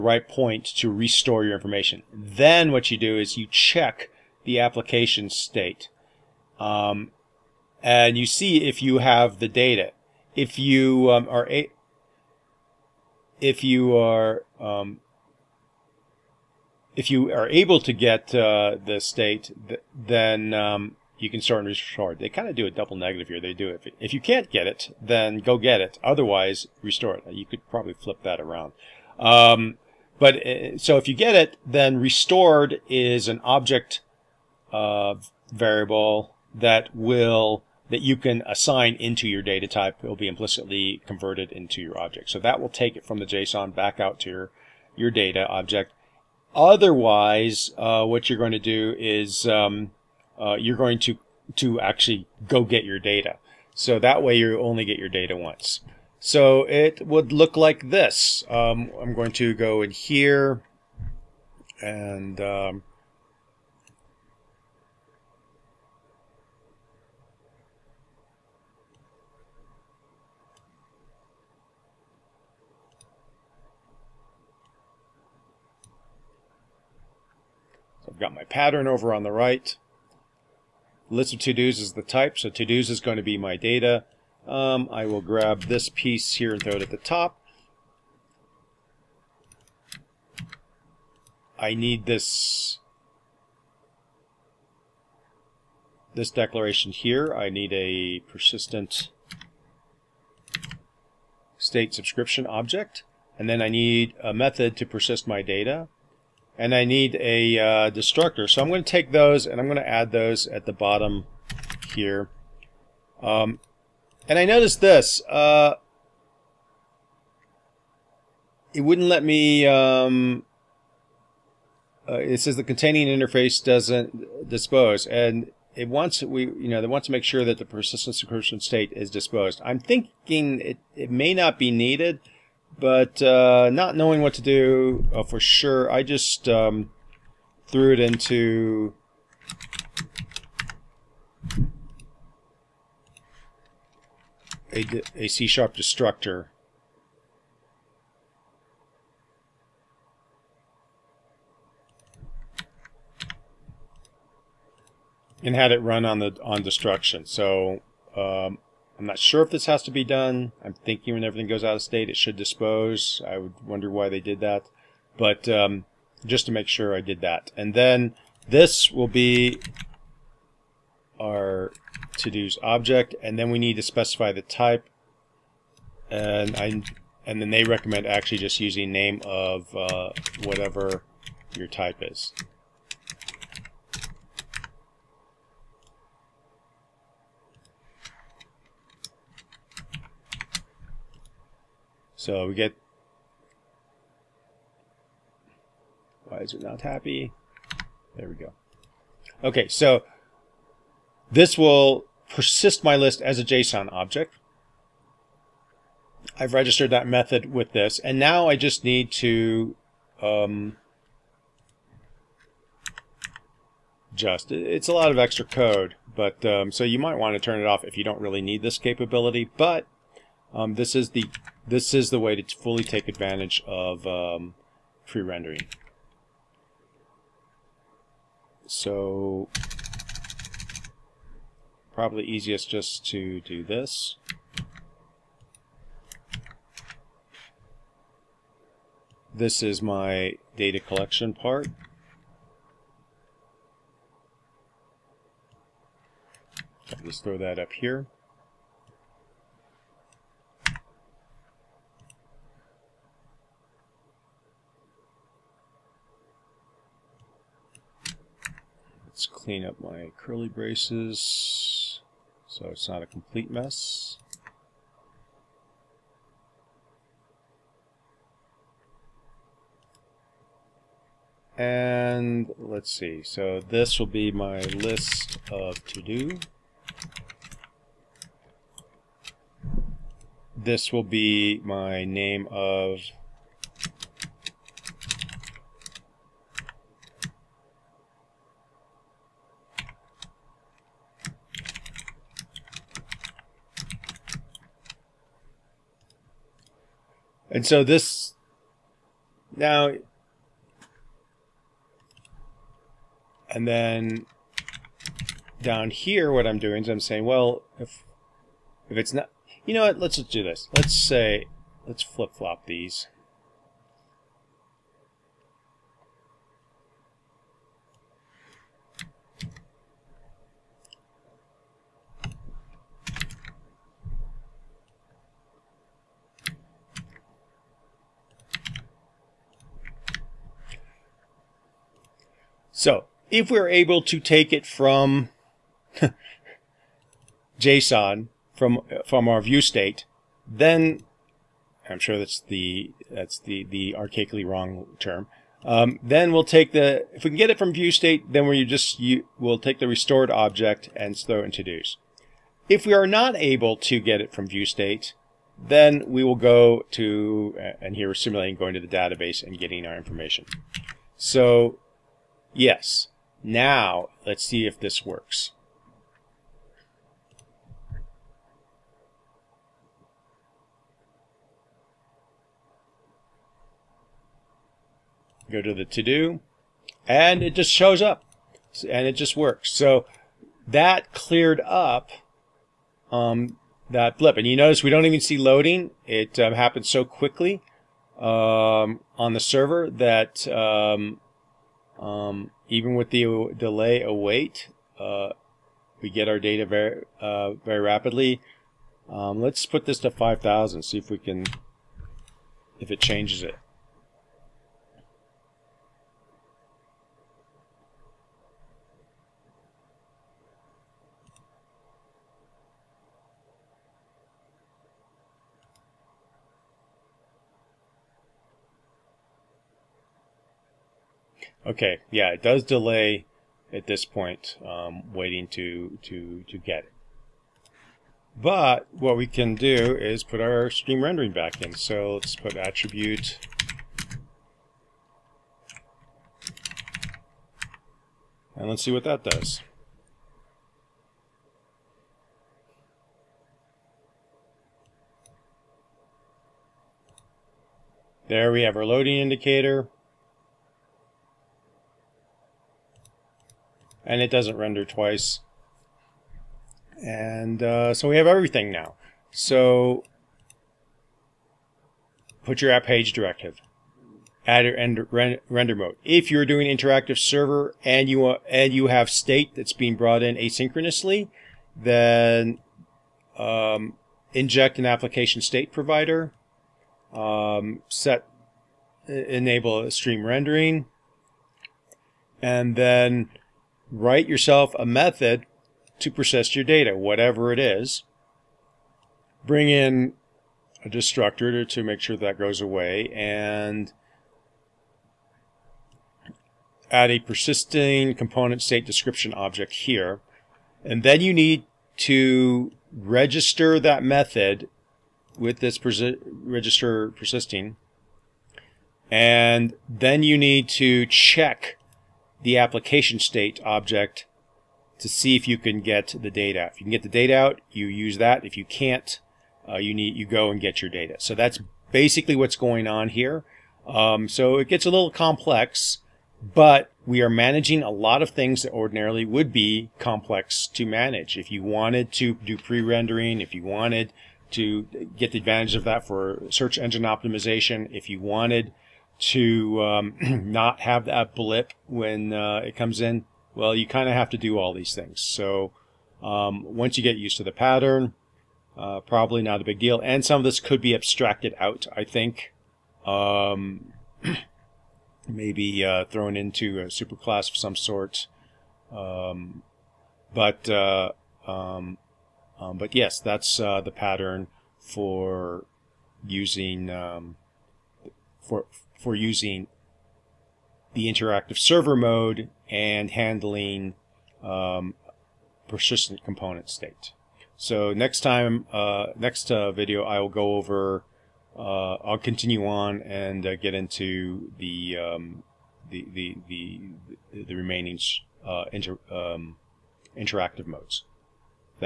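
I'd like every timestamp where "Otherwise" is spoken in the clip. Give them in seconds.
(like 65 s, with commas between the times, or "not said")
26 s, 46 s.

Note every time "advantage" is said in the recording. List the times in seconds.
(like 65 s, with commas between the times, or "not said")
223 s, 535 s.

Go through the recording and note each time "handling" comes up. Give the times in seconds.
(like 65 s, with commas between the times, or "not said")
573 s.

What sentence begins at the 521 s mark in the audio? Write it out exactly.
So that's basically what's going on here.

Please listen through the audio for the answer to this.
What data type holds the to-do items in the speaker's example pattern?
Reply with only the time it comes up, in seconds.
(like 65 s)
81 s.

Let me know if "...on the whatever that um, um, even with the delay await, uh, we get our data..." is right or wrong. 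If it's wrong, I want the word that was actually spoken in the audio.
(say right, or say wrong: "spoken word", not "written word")
wrong: "server", not "whatever".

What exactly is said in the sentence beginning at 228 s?
So probably easiest just to do this.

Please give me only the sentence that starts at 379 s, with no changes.
So that cleared up um, that blip.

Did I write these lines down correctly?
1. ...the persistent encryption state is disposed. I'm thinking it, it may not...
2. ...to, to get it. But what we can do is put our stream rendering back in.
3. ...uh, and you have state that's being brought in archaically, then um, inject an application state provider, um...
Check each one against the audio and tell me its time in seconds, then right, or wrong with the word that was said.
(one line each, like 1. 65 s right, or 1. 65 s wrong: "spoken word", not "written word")
1. 127 s right
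2. 426 s right
3. 468 s wrong: "asynchronously", not "archaically".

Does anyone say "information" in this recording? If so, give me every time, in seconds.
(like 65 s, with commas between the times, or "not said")
1 s, 359 s.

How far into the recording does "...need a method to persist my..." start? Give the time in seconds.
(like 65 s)
103 s.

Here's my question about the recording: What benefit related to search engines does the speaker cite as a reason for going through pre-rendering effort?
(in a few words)
search engine optimization.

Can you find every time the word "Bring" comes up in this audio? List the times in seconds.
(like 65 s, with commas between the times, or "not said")
489 s.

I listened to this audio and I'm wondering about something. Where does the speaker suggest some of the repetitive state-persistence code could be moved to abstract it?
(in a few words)
a superclass.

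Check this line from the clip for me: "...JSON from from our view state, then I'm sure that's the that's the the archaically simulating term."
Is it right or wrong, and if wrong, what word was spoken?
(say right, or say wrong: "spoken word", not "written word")
wrong: "wrong", not "simulating".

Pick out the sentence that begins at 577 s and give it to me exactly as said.
So next time, uh, next uh, video, I will go over.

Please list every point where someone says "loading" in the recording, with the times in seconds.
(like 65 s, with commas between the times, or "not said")
385 s, 448 s.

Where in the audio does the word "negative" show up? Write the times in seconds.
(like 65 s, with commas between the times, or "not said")
22 s.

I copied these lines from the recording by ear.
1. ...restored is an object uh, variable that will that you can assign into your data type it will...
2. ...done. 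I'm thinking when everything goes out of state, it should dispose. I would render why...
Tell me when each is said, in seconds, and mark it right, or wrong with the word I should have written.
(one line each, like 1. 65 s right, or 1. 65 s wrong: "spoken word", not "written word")
1. 31 s right
2. 160 s wrong: "wonder", not "render".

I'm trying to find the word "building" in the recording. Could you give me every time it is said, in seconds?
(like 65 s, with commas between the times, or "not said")
not said.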